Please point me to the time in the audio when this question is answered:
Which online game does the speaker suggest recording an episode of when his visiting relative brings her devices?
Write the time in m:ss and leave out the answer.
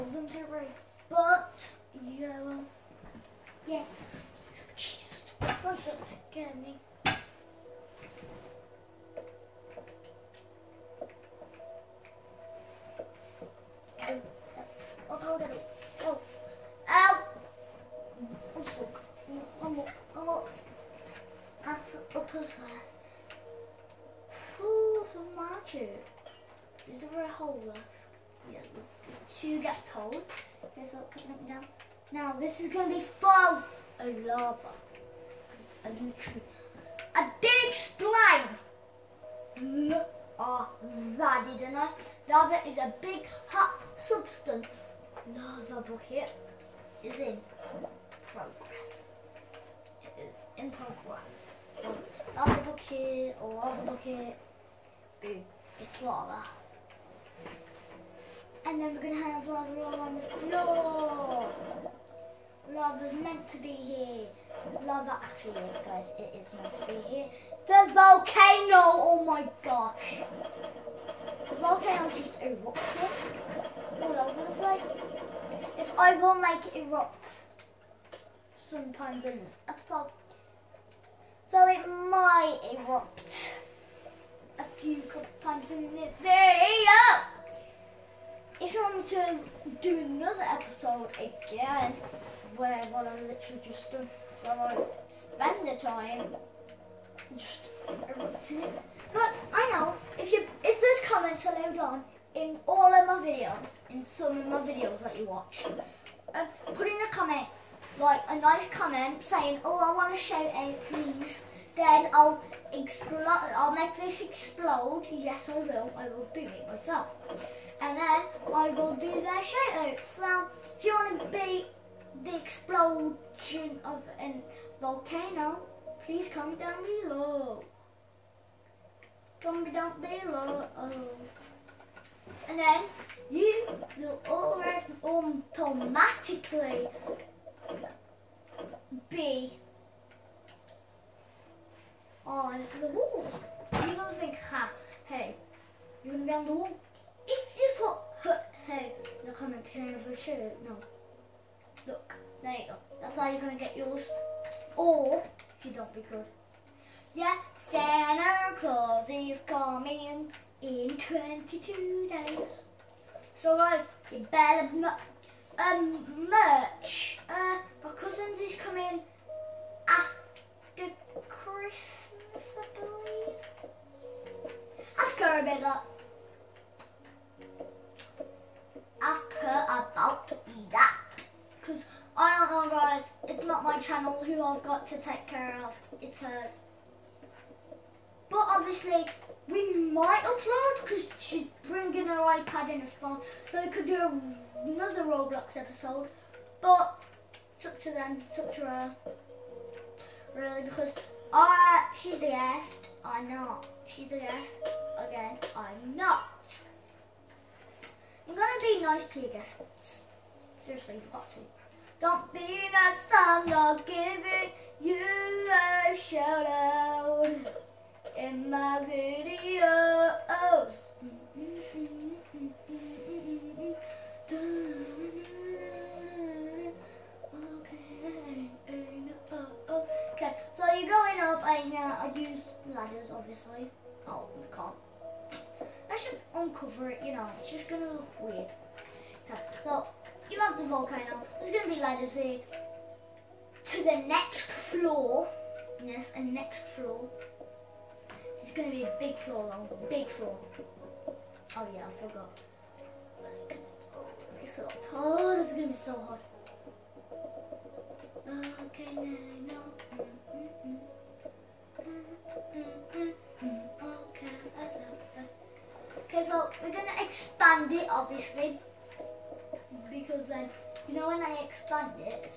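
3:15.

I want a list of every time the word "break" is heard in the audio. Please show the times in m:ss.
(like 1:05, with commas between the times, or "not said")
0:00.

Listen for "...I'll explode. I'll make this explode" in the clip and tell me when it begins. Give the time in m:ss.
1:52.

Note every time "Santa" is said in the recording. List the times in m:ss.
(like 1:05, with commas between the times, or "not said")
2:37.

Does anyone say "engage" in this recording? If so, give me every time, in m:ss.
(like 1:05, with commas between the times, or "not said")
not said.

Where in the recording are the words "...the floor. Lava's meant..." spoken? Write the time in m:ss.
1:00.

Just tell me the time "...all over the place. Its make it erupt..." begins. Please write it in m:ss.
1:13.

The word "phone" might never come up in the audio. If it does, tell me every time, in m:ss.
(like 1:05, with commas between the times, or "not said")
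3:12.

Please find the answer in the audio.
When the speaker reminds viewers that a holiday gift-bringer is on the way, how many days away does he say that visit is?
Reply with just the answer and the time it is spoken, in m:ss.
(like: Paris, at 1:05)
22, at 2:40.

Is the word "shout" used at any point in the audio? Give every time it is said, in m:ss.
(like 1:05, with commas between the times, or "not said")
1:50, 1:59.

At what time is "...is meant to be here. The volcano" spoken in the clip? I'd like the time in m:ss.
1:06.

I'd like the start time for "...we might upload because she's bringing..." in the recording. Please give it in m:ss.
3:09.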